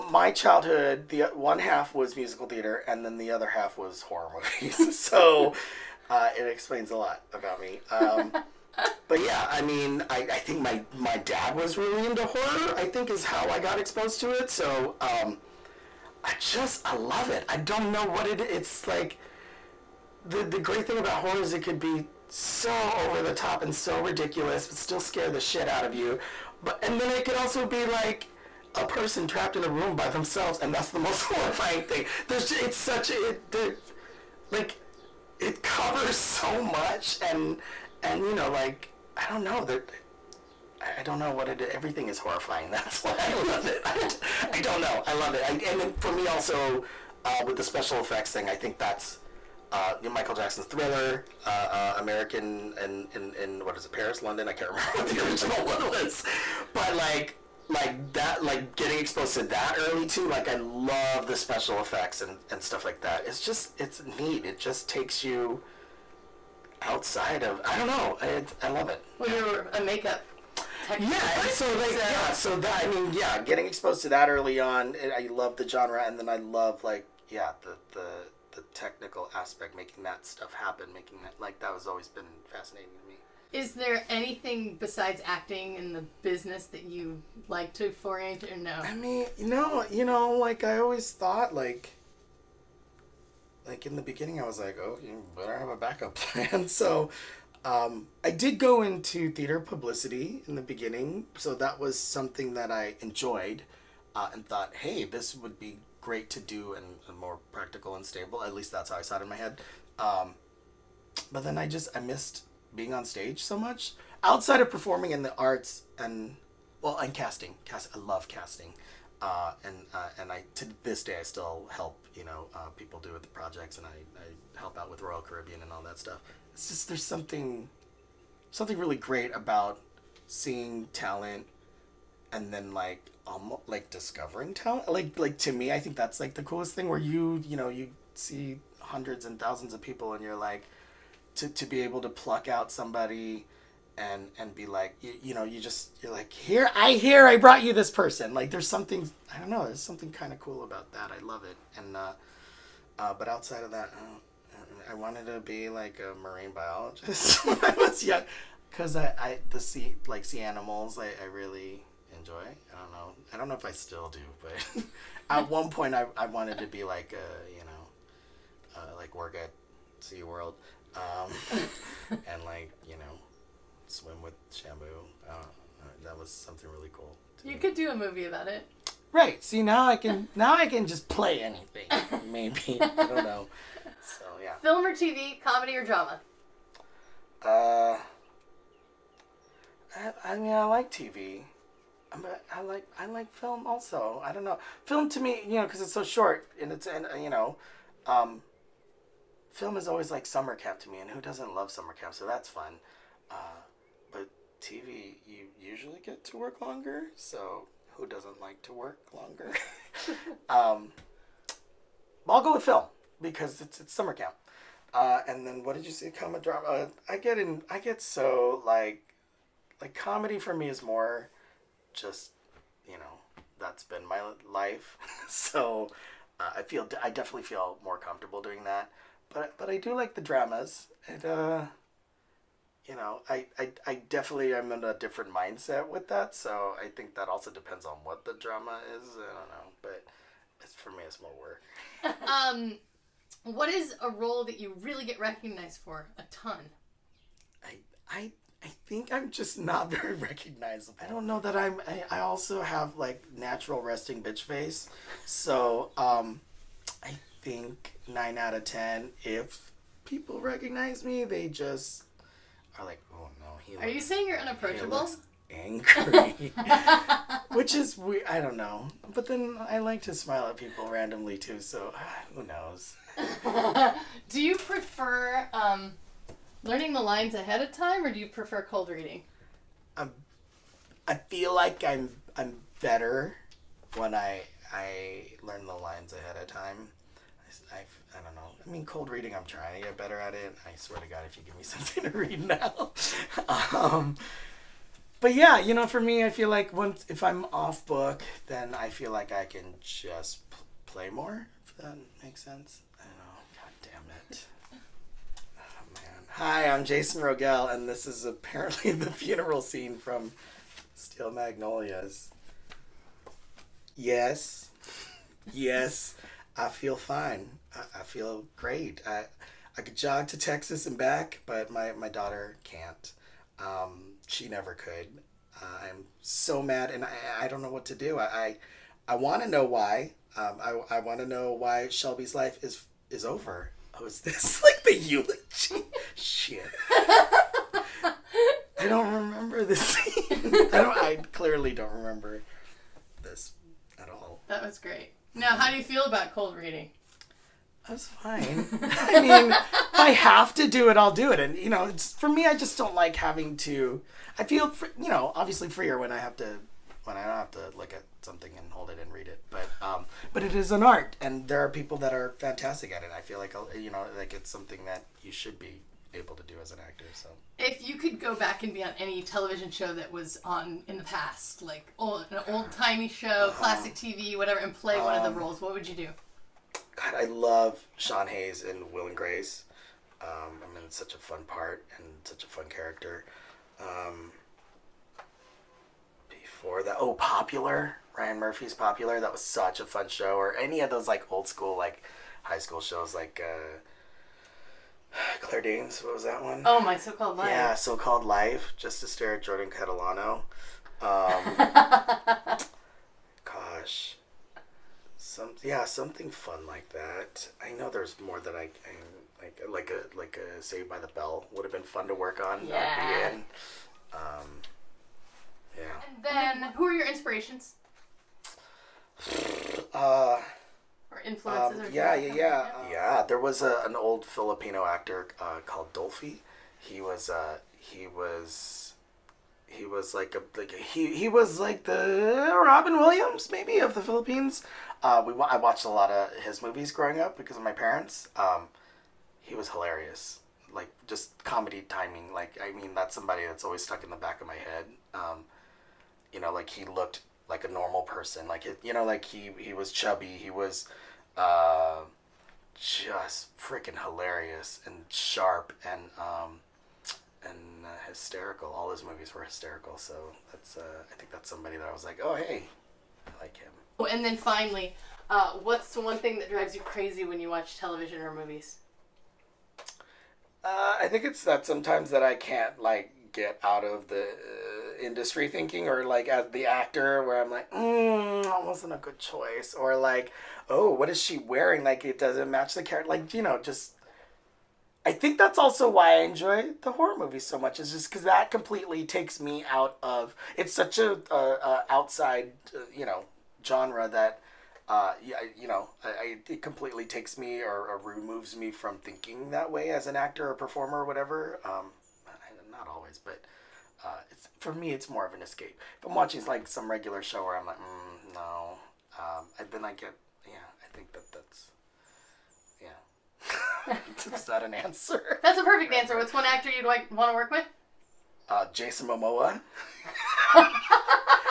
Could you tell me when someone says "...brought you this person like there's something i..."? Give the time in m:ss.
2:27.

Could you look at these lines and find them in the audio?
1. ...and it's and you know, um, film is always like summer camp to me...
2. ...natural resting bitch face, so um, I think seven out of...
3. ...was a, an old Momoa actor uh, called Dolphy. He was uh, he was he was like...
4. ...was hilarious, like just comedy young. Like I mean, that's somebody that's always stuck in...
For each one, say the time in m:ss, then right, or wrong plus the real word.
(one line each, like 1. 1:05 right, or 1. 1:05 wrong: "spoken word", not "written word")
1. 3:16 right
2. 4:13 wrong: "nine", not "seven"
3. 7:03 wrong: "Filipino", not "Momoa"
4. 7:19 wrong: "timing", not "young".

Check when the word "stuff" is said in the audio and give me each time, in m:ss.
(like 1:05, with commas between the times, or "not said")
1:02, 1:20, 2:05.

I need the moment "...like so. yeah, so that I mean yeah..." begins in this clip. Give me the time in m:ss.
1:11.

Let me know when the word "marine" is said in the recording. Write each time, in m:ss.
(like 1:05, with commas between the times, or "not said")
2:36.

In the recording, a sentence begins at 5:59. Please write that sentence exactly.
But um, but it is an art, and there are people that are fantastic at it.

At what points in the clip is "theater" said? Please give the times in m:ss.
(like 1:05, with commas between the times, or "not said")
0:02, 1:39.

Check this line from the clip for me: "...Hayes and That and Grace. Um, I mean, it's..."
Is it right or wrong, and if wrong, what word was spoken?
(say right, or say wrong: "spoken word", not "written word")
wrong: "Will", not "That".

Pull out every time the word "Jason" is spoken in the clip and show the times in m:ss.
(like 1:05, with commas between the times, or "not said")
5:06, 8:38.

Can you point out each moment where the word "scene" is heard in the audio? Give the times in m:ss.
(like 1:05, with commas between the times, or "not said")
5:09, 5:39.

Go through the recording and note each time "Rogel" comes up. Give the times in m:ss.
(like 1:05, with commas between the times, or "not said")
5:07.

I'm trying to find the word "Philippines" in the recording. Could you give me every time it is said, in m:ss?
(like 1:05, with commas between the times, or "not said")
7:14.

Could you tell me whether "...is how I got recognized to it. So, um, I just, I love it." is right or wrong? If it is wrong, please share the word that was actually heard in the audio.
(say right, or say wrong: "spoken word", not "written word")
wrong: "exposed", not "recognized".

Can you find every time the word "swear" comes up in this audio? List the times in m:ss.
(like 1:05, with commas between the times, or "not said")
4:50.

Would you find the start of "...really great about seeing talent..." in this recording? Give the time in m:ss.
2:08.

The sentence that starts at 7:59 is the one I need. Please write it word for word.
Or like, oh, what is she wearing?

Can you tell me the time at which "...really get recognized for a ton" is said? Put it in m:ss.
4:04.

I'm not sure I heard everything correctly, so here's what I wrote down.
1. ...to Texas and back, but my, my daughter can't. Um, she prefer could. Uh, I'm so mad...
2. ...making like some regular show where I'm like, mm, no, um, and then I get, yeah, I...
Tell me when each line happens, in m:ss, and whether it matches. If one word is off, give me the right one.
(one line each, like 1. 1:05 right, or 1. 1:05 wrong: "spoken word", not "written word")
1. 5:20 wrong: "never", not "prefer"
2. 8:26 wrong: "watching", not "making".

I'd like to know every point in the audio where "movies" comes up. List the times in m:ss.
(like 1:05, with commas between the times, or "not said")
0:04, 2:57, 7:16, 7:39, 7:48, 8:07.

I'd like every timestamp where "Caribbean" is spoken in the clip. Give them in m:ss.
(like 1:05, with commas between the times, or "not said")
2:05.